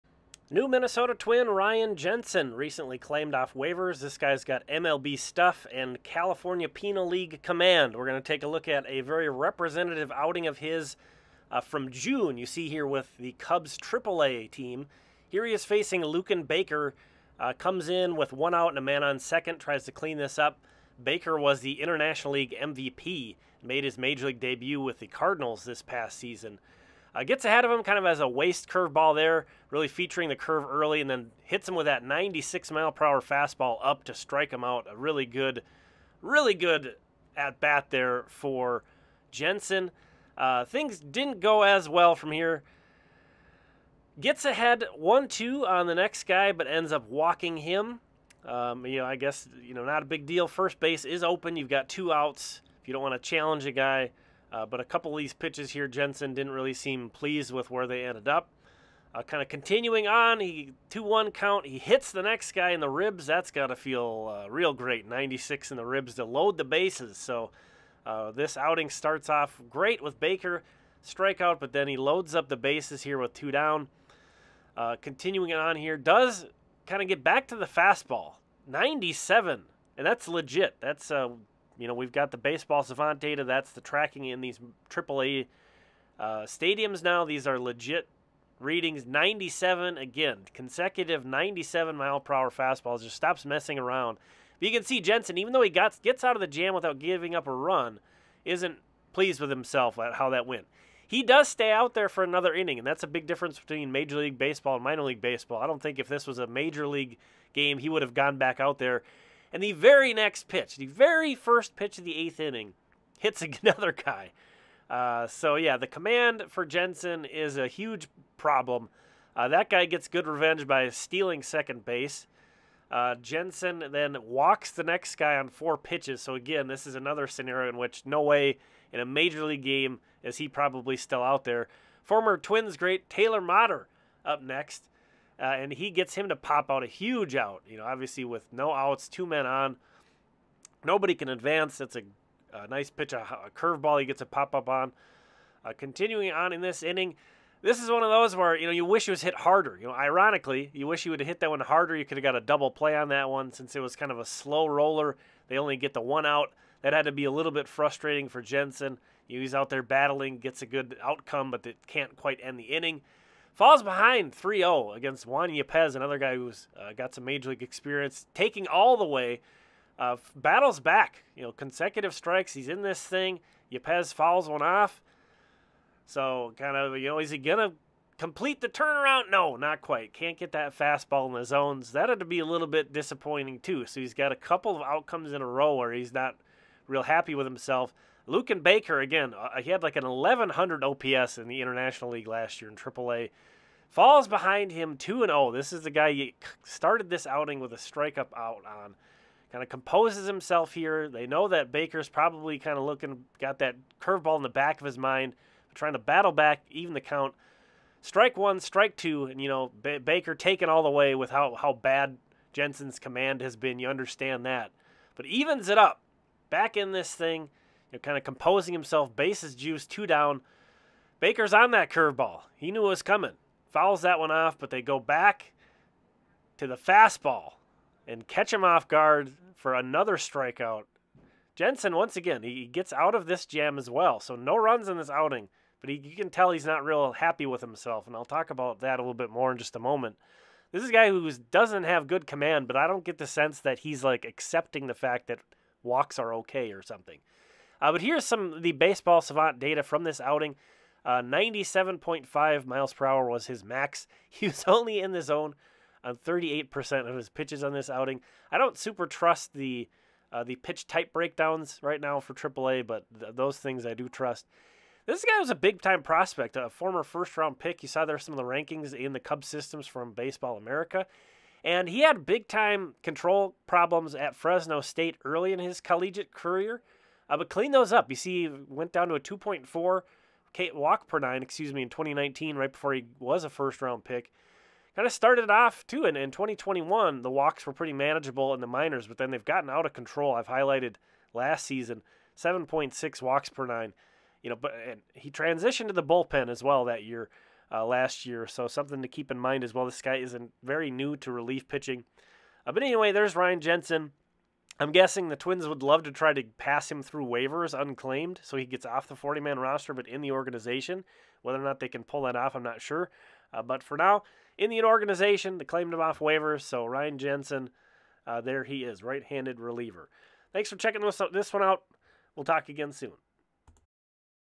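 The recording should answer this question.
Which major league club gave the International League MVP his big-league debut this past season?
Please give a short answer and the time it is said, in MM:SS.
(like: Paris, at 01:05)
Cardinals, at 00:25.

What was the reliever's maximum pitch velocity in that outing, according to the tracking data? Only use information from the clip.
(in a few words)
97.5 mph.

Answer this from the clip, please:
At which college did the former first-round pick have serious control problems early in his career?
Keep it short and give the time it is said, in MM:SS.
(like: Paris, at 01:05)
Fresno State, at 04:34.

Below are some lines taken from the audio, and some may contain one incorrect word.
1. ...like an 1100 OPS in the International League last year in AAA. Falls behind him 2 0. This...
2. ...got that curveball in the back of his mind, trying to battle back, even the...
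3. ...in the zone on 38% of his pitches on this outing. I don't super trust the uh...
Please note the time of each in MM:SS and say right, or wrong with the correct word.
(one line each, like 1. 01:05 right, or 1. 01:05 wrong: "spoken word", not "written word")
1. 03:09 right
2. 03:23 right
3. 04:14 right.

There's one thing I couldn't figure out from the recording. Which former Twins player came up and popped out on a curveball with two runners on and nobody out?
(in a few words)
Taylor Motter.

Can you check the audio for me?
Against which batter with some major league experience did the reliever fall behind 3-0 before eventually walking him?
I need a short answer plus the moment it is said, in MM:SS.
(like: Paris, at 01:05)
Juan Yepez, at 02:45.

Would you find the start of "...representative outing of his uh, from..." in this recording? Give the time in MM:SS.
00:09.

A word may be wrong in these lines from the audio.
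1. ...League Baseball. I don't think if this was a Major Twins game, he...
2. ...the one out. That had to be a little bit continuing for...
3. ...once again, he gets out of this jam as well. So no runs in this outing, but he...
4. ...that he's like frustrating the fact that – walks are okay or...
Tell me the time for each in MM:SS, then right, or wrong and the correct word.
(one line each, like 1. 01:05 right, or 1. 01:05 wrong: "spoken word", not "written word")
1. 01:45 wrong: "League", not "Twins"
2. 02:35 wrong: "frustrating", not "continuing"
3. 03:51 right
4. 04:03 wrong: "accepting", not "frustrating".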